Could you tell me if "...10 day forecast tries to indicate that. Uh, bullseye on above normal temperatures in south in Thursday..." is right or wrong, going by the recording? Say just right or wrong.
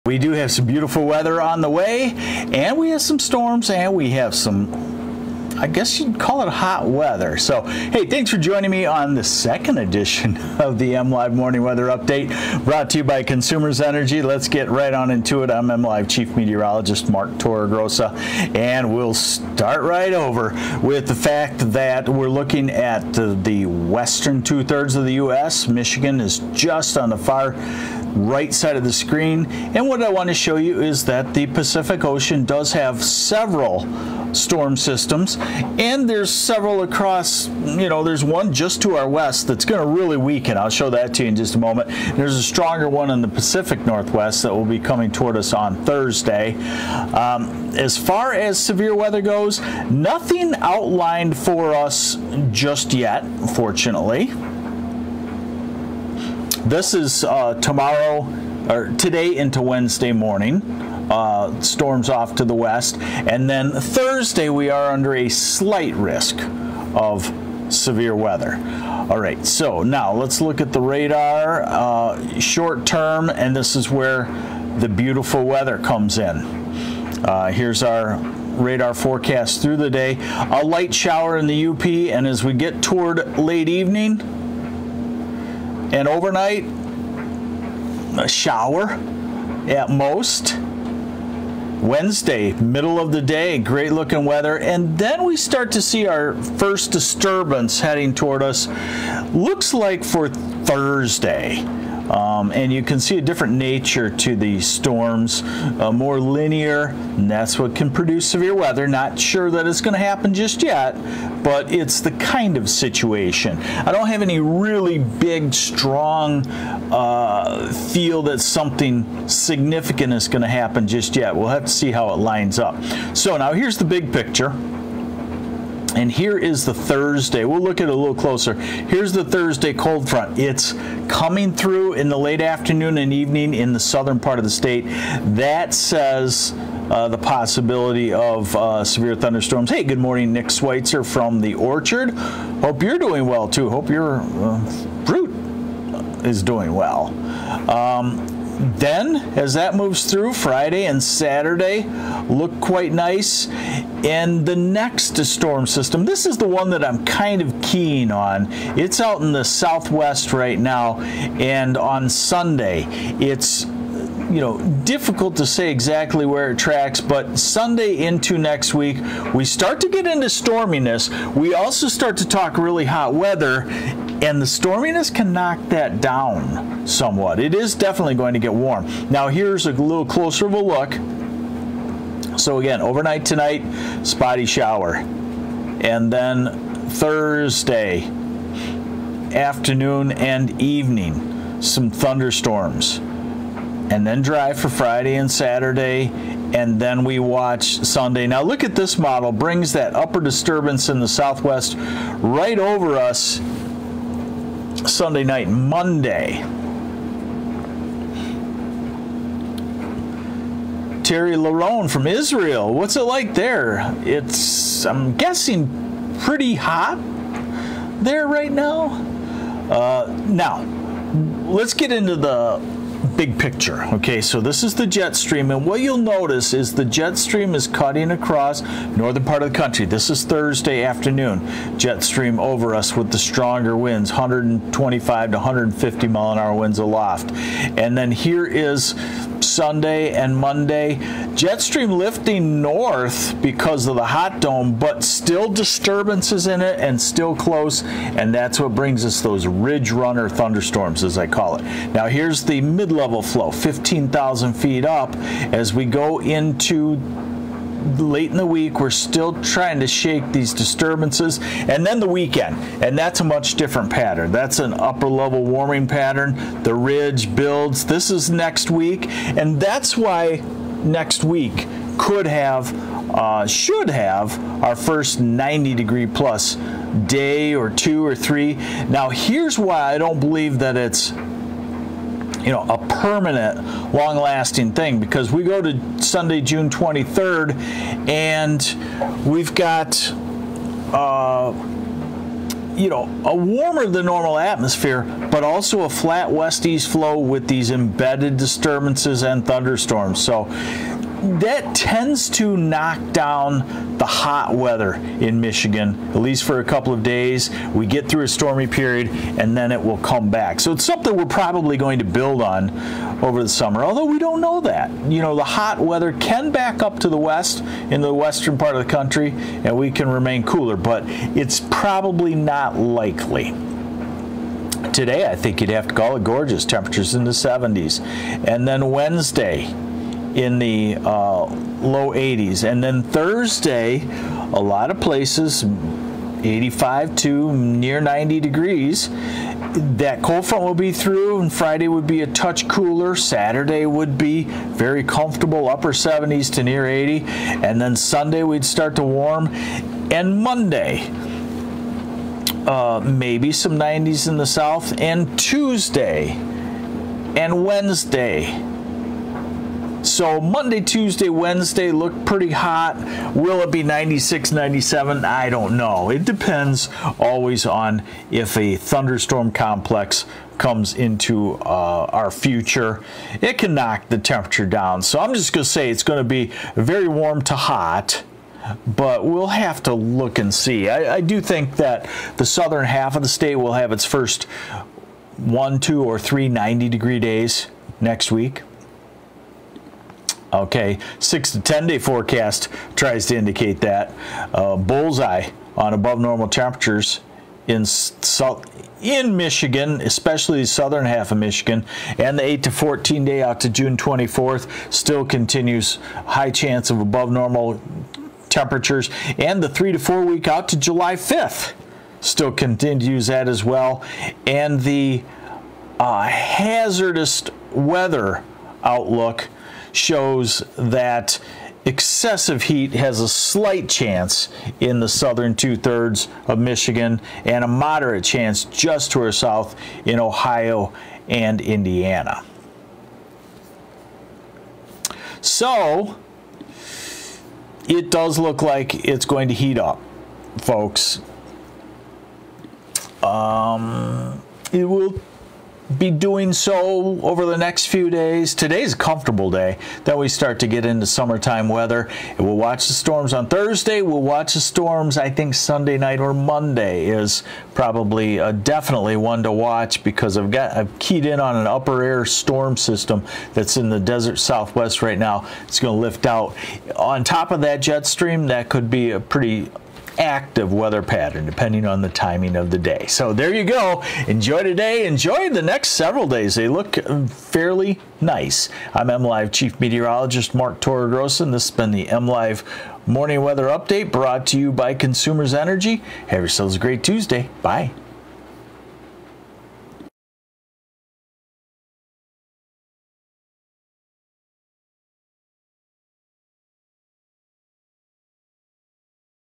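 wrong.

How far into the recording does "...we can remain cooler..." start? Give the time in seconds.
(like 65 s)
319 s.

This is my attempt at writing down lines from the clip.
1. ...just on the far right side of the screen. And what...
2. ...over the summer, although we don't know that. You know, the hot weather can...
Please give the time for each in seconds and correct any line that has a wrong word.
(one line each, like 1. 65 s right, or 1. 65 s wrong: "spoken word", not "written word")
1. 26 s right
2. 313 s right.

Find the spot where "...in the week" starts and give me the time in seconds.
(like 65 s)
258 s.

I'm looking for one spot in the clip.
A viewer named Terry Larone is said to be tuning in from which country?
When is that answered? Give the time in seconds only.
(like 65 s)
212 s.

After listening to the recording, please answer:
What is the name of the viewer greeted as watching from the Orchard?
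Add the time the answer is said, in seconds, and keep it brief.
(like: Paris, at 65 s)
Nick Schweitzer, at 140 s.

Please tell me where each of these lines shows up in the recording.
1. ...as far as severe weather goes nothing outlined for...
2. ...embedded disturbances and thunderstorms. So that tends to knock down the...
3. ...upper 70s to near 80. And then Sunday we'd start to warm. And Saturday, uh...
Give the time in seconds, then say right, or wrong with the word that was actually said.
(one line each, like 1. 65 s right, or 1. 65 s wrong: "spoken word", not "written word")
1. 47 s right
2. 297 s right
3. 345 s wrong: "Monday", not "Saturday".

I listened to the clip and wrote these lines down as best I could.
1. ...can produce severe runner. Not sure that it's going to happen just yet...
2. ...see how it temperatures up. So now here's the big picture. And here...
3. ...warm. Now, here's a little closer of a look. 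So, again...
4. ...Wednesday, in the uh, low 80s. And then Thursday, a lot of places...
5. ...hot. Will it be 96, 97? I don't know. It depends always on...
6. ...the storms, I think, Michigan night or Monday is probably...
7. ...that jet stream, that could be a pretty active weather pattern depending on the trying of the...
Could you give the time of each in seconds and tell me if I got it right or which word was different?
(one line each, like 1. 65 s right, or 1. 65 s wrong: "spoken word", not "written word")
1. 107 s wrong: "weather", not "runner"
2. 121 s wrong: "lines", not "temperatures"
3. 178 s right
4. 328 s right
5. 362 s right
6. 454 s wrong: "Sunday", not "Michigan"
7. 467 s wrong: "timing", not "trying".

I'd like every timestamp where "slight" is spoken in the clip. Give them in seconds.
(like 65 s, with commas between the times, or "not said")
65 s, 423 s.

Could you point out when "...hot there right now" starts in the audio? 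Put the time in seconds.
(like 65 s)
216 s.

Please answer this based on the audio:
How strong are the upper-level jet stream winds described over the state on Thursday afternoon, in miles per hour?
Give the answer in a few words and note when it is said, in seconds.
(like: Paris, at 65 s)
125 to 150, at 234 s.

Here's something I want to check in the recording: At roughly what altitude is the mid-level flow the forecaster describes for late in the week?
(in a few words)
15,000 feet.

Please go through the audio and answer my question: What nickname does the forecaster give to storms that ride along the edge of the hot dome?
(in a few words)
ridge runner thunderstorms.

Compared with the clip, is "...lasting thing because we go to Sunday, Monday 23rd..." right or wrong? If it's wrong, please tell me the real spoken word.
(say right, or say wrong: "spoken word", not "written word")
wrong: "June", not "Monday".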